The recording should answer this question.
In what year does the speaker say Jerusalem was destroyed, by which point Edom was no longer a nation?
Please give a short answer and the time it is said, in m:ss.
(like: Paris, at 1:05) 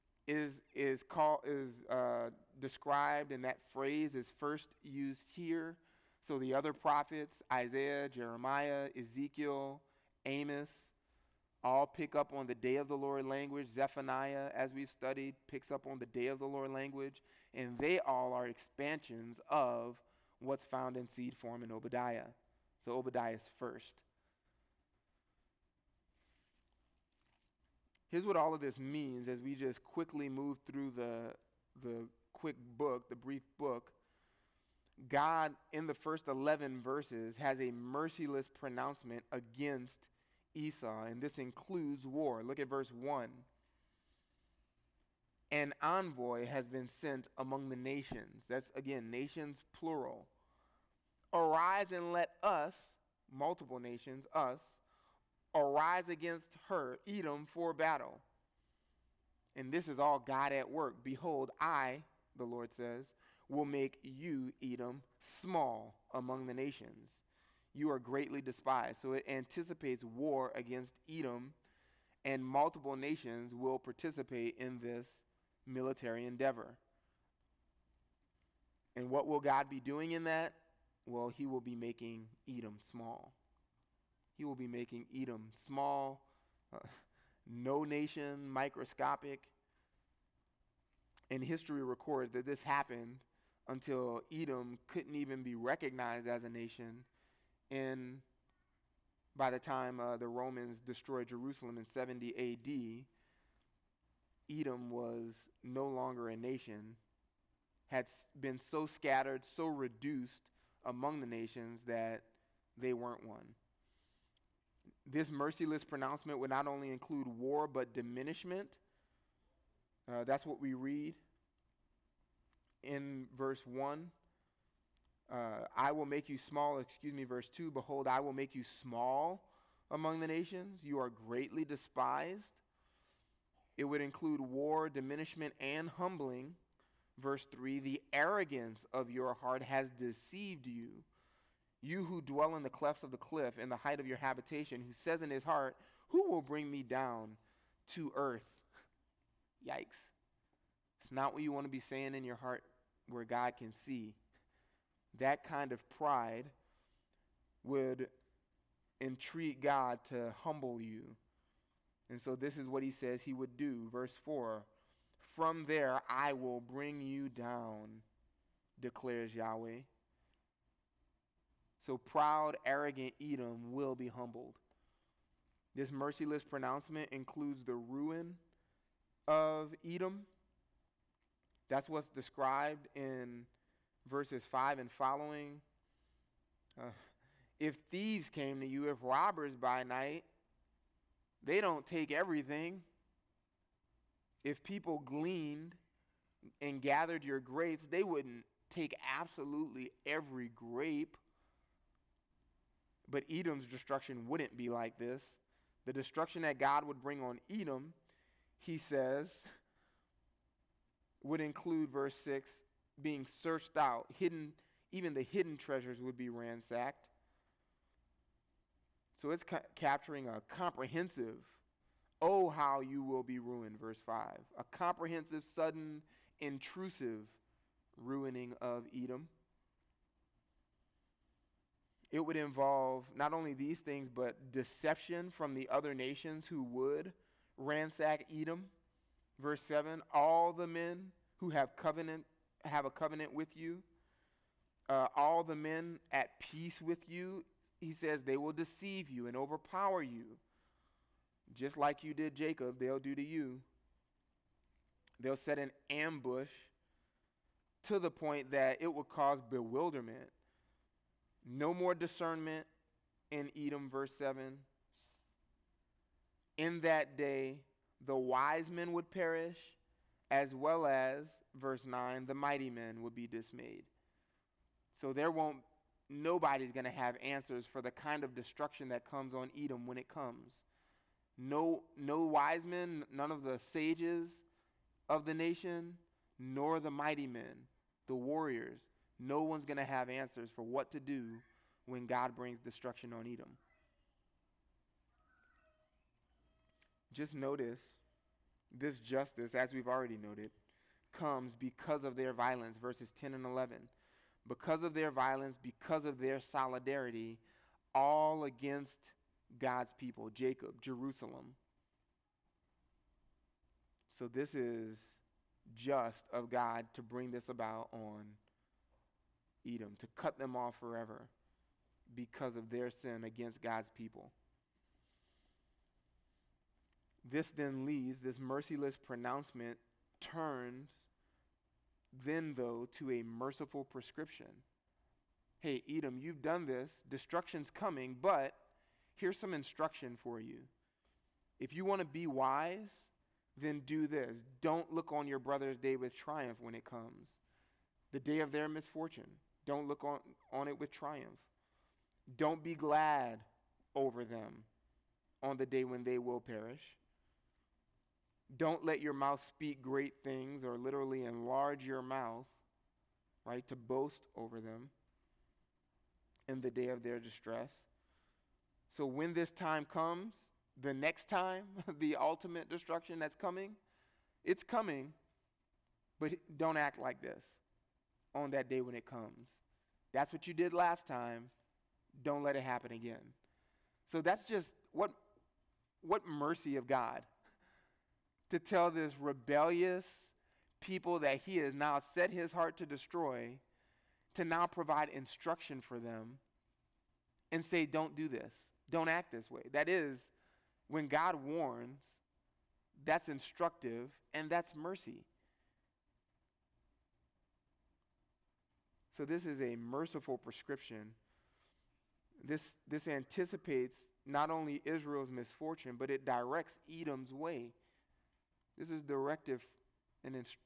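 70 AD, at 1:41.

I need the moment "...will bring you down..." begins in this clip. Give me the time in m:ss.
2:46.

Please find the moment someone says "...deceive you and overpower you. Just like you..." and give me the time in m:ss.
4:08.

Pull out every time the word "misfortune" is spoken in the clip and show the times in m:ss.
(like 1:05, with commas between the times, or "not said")
5:48, 6:55.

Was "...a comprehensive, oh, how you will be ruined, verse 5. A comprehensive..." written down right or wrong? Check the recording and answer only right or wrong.
right.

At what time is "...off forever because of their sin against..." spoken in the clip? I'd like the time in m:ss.
5:20.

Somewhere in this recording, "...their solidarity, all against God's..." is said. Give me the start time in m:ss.
5:06.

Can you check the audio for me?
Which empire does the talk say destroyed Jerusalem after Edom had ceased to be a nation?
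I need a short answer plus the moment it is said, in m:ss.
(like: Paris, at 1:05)
The Romans, at 1:40.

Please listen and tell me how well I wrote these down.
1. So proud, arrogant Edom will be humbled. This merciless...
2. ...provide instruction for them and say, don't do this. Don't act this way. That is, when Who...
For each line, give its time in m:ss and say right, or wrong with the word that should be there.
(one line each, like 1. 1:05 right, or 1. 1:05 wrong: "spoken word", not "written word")
1. 2:51 right
2. 6:34 wrong: "God", not "Who".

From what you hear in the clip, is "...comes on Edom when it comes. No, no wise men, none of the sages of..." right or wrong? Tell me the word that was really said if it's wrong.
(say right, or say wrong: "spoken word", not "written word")
right.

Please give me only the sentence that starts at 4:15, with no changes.
They'll set an ambush to the point that it will cause bewilderment no more discernment in Edom, verse 7.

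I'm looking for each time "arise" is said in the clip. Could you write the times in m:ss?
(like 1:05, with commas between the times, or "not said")
0:51, 0:55.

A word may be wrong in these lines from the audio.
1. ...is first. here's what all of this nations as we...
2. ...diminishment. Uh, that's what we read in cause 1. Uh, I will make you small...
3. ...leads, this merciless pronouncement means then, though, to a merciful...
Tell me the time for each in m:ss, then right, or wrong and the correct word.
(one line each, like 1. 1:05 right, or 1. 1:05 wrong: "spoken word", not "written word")
1. 0:23 wrong: "means", not "nations"
2. 1:57 wrong: "verse", not "cause"
3. 5:27 wrong: "turns", not "means".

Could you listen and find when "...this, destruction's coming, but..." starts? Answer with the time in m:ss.
5:36.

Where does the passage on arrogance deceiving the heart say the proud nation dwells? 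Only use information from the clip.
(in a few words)
Clefts of the cliff.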